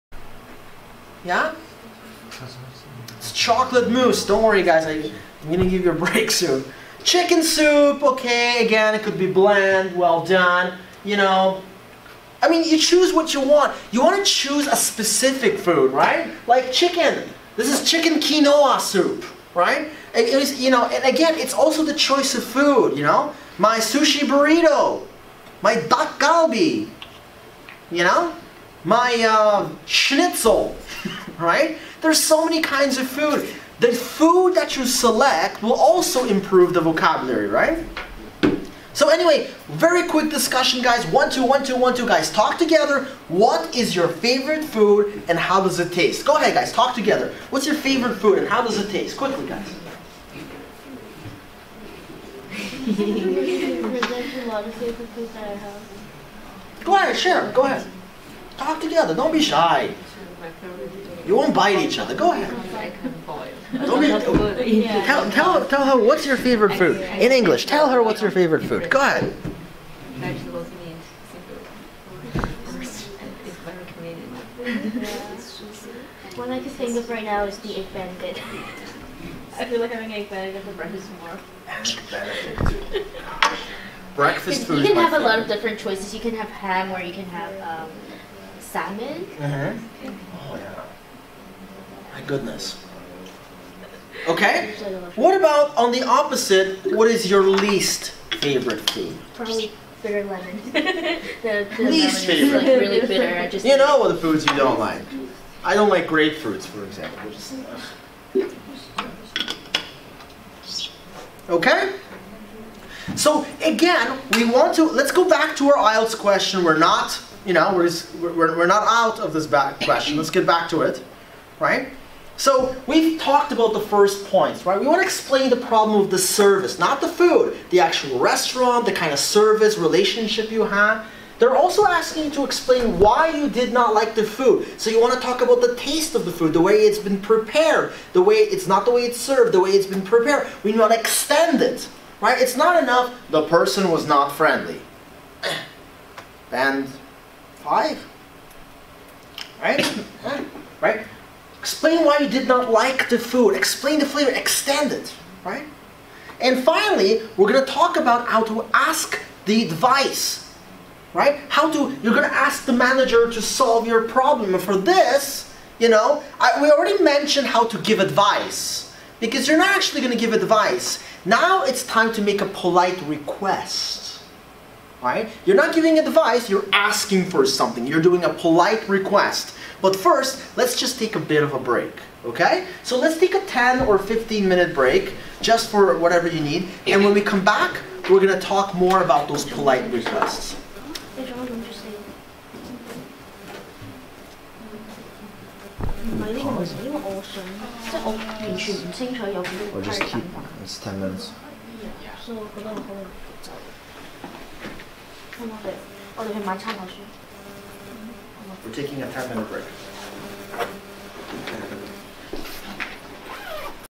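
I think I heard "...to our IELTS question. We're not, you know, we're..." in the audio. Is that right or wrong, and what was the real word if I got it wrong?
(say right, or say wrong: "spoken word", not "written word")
right.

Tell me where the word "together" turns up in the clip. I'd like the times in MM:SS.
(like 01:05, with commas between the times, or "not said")
00:42, 00:46, 00:58.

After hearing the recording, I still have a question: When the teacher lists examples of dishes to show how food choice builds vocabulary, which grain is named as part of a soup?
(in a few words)
quinoa.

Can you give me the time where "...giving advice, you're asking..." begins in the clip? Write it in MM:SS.
02:55.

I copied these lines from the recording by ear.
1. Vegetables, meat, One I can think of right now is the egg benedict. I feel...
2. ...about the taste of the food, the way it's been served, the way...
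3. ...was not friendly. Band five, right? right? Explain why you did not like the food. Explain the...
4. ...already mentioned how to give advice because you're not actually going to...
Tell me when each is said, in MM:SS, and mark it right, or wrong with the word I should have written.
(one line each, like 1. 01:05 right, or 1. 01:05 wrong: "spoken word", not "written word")
1. 01:10 right
2. 02:15 wrong: "prepared", not "served"
3. 02:23 right
4. 02:46 right.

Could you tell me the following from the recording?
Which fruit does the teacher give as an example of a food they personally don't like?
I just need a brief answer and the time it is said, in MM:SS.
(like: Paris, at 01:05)
grapefruits, at 01:46.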